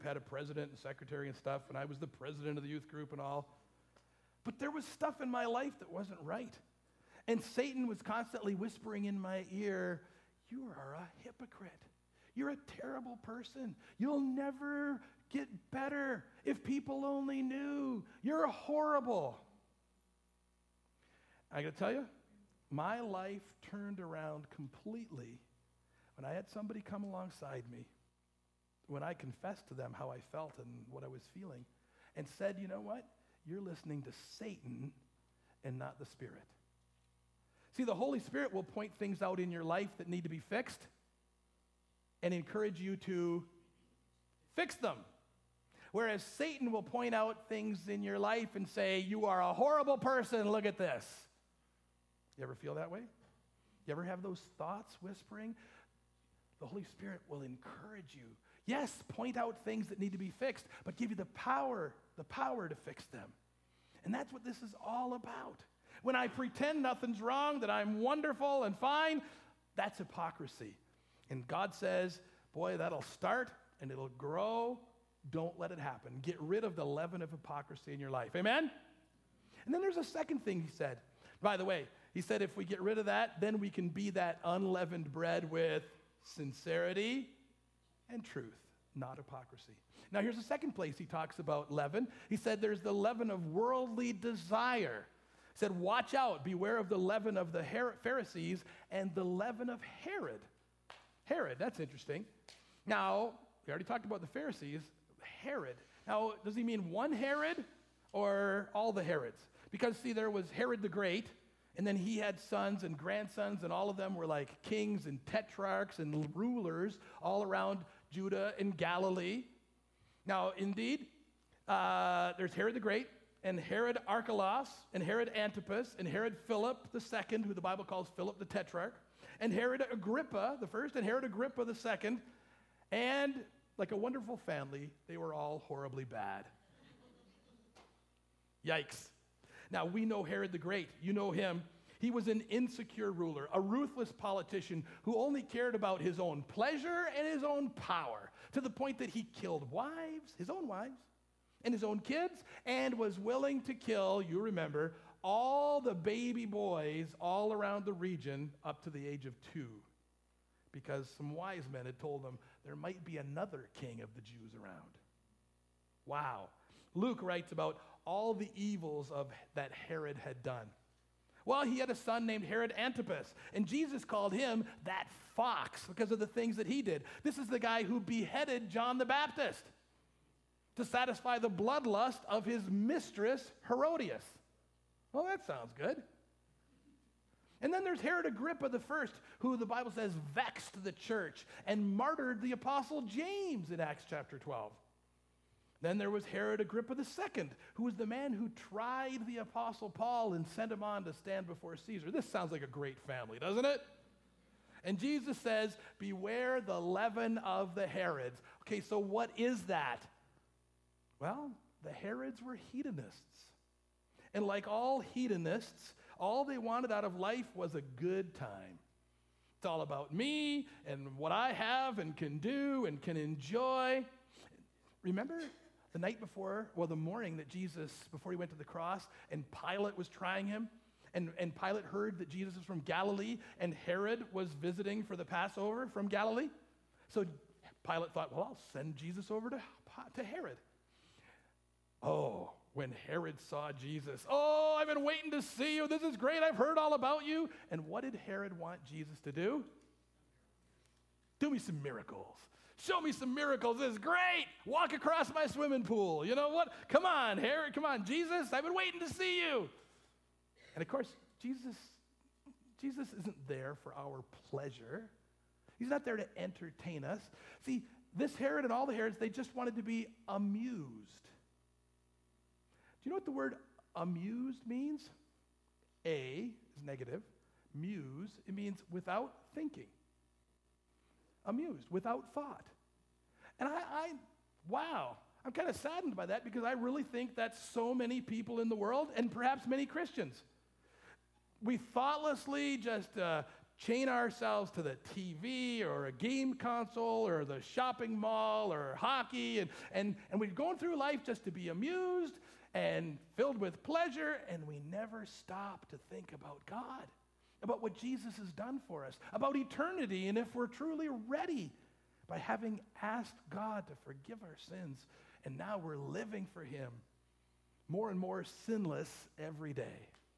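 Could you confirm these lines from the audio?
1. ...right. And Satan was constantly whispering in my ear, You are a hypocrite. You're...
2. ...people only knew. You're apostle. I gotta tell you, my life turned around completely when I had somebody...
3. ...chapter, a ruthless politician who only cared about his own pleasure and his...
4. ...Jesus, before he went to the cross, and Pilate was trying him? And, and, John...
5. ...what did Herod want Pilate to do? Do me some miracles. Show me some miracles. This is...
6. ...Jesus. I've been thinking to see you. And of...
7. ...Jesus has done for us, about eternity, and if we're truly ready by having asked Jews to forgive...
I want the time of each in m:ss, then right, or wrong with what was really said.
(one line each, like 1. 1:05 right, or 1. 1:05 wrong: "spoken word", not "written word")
1. 0:06 right
2. 0:16 wrong: "horrible", not "apostle"
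3. 2:23 wrong: "ruler", not "chapter"
4. 3:47 wrong: "Pilate", not "John"
5. 4:07 wrong: "Jesus", not "Pilate"
6. 4:18 wrong: "waiting", not "thinking"
7. 5:07 wrong: "God", not "Jews".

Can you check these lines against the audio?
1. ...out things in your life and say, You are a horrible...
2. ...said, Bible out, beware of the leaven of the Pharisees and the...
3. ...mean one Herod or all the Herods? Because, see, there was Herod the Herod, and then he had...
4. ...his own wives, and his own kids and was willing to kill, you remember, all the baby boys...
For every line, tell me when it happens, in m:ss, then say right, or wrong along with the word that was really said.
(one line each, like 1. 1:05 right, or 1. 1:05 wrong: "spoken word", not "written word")
1. 0:47 right
2. 1:35 wrong: "Watch", not "Bible"
3. 1:46 wrong: "Great", not "Herod"
4. 2:30 right.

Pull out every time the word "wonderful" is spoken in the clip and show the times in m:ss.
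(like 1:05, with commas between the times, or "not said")
1:07, 2:13.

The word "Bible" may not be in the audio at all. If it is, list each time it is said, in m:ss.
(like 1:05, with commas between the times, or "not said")
2:07, 3:09.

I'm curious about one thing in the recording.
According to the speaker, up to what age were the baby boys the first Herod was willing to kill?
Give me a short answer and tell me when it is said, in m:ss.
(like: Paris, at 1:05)
2, at 2:39.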